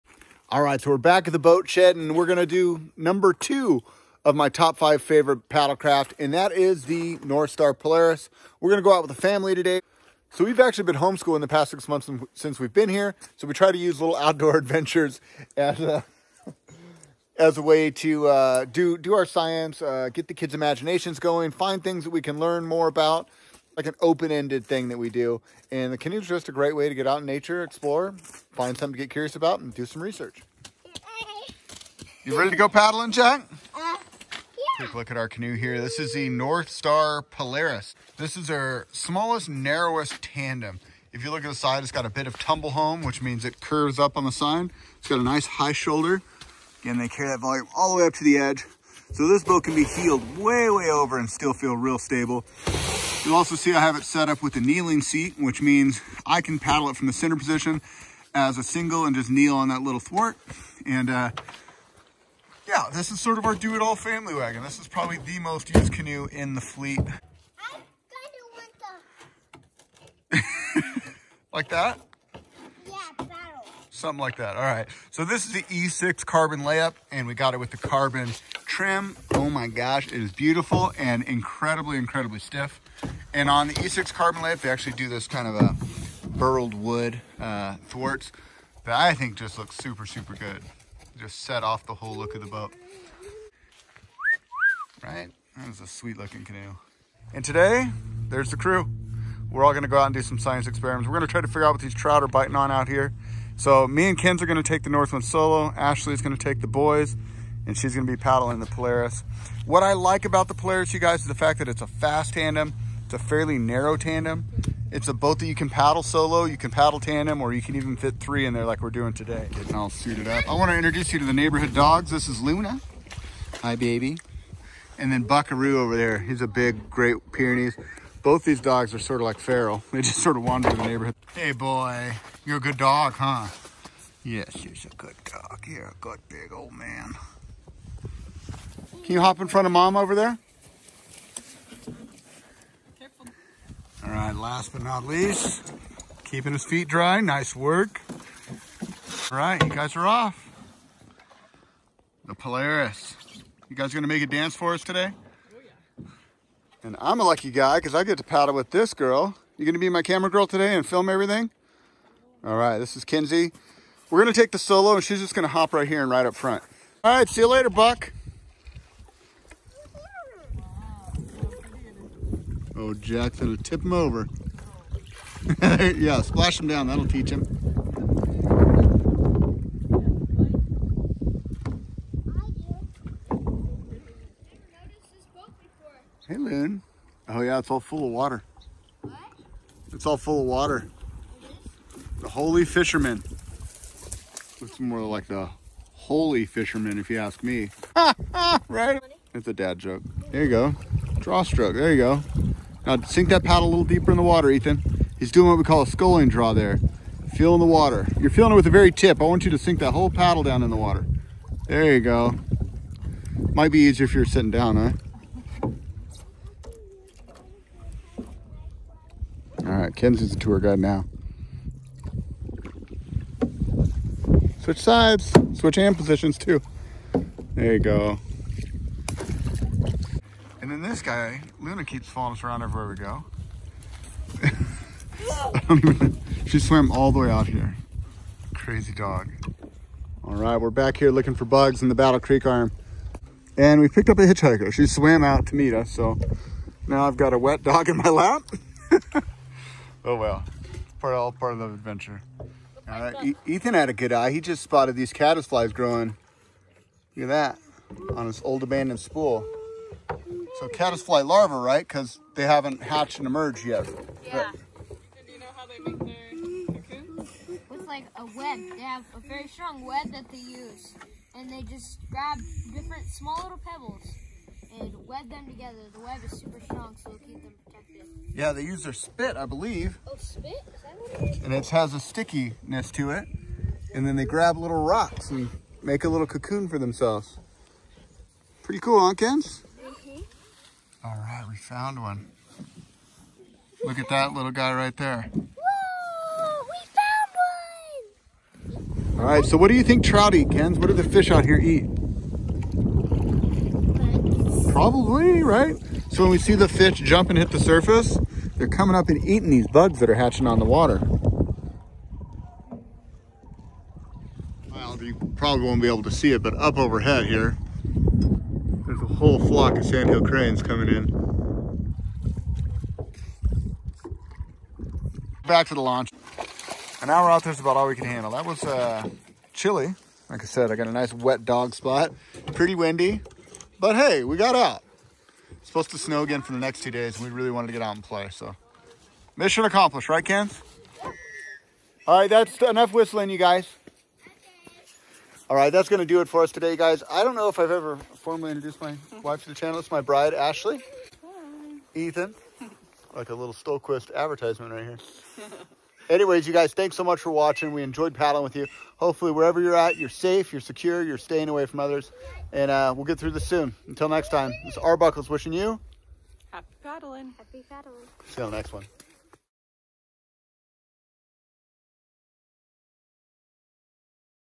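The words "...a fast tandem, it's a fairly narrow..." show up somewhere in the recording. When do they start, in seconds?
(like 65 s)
111 s.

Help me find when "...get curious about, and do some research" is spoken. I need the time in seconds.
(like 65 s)
29 s.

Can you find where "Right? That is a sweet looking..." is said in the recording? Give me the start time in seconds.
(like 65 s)
95 s.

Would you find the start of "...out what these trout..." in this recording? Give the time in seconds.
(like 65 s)
101 s.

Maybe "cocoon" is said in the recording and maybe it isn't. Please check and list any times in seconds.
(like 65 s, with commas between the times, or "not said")
266 s, 286 s.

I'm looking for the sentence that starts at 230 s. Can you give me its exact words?
And then this guy, Luna keeps following us around everywhere we go.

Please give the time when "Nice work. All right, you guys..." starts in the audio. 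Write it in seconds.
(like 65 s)
147 s.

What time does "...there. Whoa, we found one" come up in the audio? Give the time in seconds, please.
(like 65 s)
294 s.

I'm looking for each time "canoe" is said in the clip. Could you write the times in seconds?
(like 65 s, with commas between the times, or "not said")
25 s, 35 s, 65 s, 96 s.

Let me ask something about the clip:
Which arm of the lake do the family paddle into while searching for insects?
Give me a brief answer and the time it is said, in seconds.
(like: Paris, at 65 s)
Battle Creek arm, at 241 s.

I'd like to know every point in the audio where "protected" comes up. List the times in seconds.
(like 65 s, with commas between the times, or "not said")
277 s.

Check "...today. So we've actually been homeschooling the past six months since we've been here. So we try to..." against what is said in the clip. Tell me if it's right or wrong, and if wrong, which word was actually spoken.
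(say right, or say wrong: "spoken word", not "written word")
right.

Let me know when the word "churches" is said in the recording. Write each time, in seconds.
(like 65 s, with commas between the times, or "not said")
not said.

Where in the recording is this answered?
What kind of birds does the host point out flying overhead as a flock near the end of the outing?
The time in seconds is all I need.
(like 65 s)
319 s.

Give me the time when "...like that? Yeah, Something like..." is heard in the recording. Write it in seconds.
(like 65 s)
71 s.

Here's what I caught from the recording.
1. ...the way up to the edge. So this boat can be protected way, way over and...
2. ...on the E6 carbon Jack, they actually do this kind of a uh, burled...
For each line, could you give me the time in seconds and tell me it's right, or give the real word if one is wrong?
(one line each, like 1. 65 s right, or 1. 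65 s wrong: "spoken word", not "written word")
1. 47 s wrong: "heeled", not "protected"
2. 83 s wrong: "Lite", not "Jack".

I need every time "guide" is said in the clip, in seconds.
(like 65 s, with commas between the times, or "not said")
220 s.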